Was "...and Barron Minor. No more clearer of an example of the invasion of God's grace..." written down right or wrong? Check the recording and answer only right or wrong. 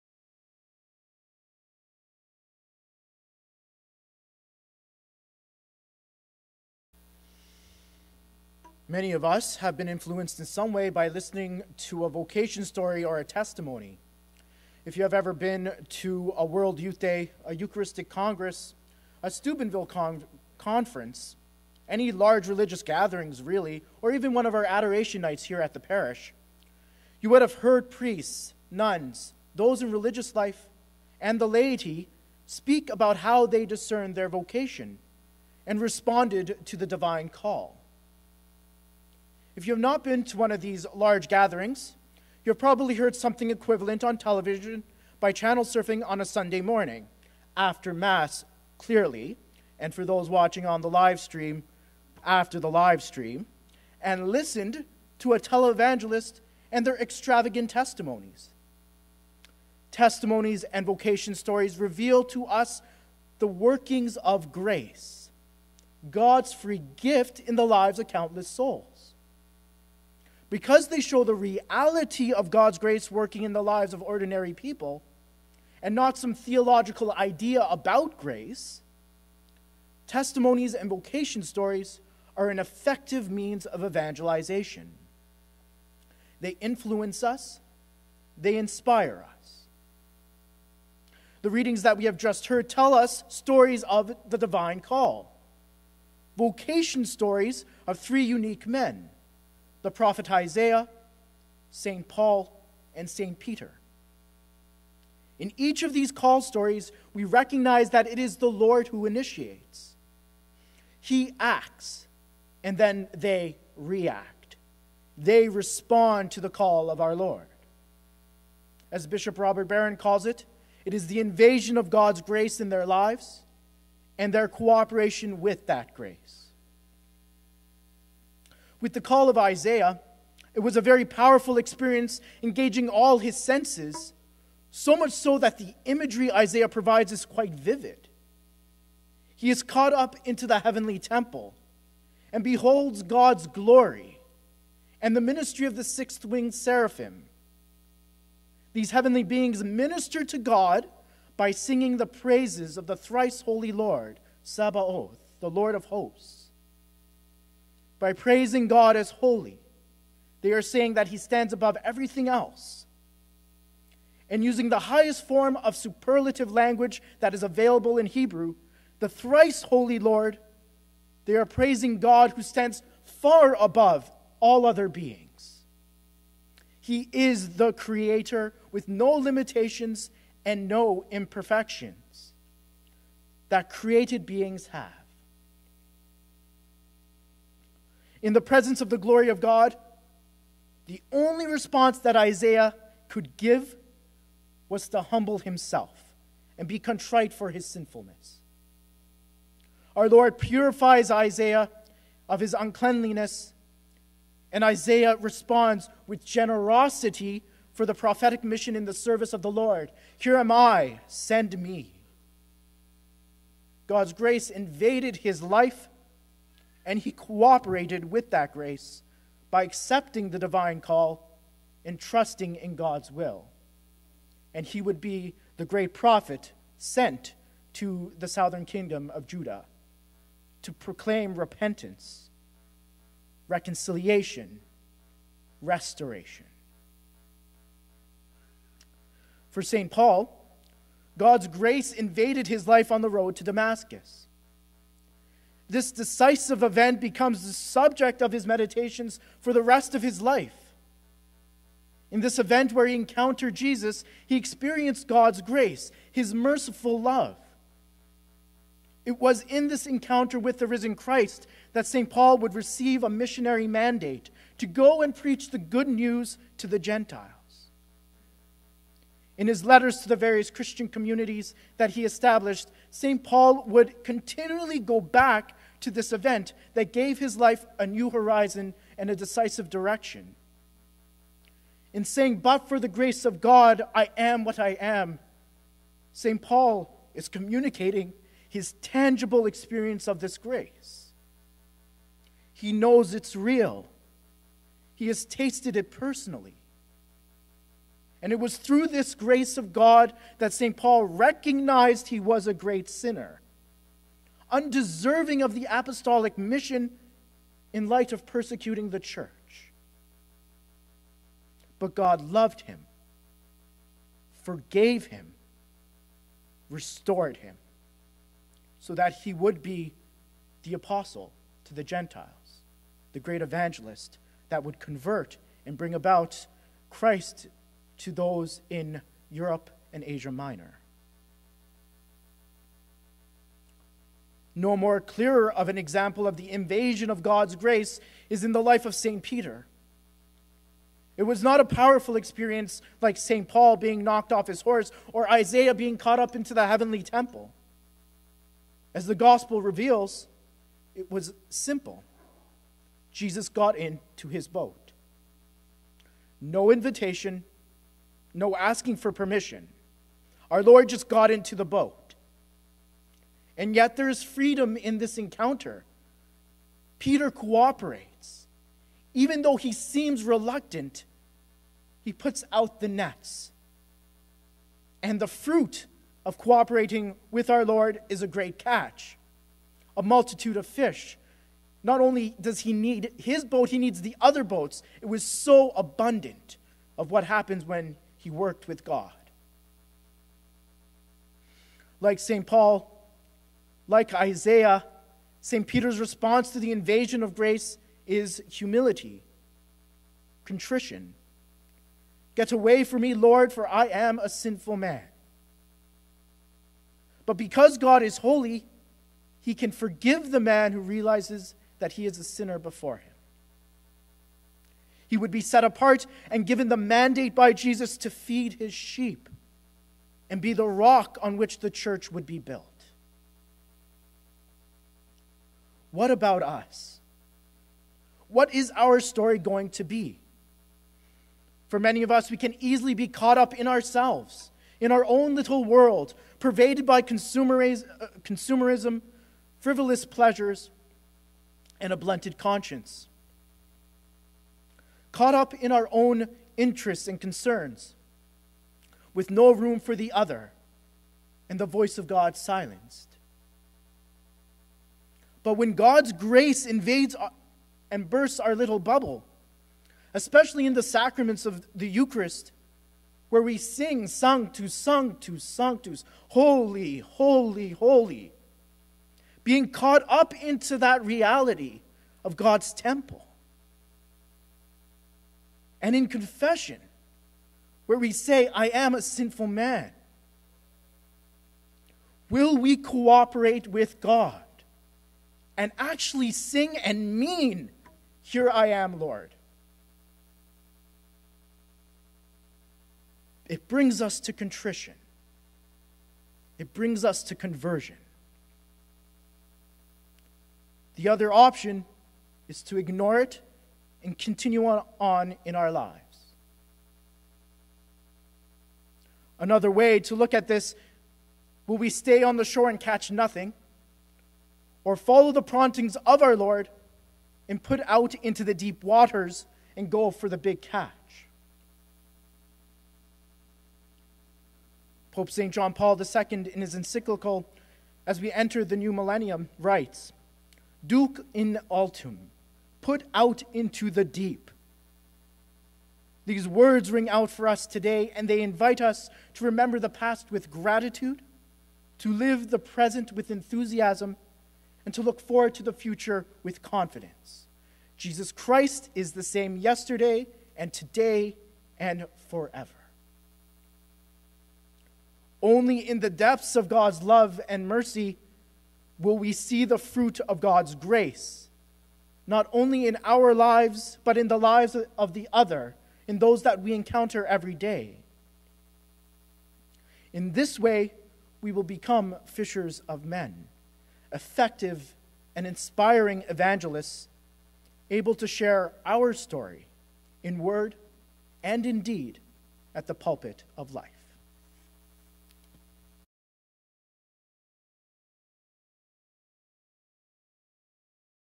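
wrong.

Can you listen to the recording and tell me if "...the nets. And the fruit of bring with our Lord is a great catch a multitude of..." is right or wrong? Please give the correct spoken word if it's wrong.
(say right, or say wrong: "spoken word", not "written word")
wrong: "cooperating", not "bring".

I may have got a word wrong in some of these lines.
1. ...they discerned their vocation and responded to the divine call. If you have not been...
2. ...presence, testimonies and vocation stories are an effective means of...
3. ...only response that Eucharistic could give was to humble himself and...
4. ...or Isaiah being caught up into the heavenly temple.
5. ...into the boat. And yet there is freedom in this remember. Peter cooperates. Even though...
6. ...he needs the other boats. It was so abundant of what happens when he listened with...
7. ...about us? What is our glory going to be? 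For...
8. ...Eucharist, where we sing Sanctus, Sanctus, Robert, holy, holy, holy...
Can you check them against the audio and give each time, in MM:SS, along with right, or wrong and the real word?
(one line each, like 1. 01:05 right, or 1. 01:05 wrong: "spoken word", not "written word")
1. 00:33 right
2. 01:18 wrong: "grace", not "presence"
3. 03:11 wrong: "Isaiah", not "Eucharistic"
4. 05:45 right
5. 06:01 wrong: "encounter", not "remember"
6. 06:23 wrong: "worked", not "listened"
7. 07:06 wrong: "story", not "glory"
8. 07:41 wrong: "Sanctus", not "Robert".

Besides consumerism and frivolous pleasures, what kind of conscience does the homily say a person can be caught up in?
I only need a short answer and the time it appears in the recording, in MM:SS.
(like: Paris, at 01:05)
blunted conscience, at 07:21.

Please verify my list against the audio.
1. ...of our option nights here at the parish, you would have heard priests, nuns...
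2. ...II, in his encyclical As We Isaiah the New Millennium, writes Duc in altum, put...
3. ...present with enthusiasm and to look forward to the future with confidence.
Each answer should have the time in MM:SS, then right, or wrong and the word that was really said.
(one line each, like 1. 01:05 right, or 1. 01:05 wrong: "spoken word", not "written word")
1. 00:24 wrong: "adoration", not "option"
2. 08:45 wrong: "Enter", not "Isaiah"
3. 09:02 right.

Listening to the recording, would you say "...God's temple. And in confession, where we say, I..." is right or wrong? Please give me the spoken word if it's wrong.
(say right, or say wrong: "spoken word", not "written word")
right.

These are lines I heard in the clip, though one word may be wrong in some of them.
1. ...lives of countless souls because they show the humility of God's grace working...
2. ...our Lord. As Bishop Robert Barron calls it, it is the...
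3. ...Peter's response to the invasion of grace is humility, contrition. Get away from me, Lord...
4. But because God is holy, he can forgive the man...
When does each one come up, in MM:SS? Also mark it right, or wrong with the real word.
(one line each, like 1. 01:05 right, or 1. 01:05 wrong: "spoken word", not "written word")
1. 01:07 wrong: "reality", not "humility"
2. 01:57 right
3. 06:35 right
4. 06:47 right.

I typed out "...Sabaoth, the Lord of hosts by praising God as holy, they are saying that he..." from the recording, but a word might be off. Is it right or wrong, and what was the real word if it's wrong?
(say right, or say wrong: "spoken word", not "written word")
right.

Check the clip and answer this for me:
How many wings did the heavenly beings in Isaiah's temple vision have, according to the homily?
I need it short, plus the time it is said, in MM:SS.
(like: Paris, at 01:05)
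6, at 02:25.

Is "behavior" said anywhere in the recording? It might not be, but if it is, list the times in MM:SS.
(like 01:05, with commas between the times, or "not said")
not said.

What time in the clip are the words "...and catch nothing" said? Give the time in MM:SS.
08:32.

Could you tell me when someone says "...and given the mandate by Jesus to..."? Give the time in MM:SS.
06:56.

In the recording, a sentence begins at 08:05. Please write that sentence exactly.
and actually sing and mean, Here I am, Lord.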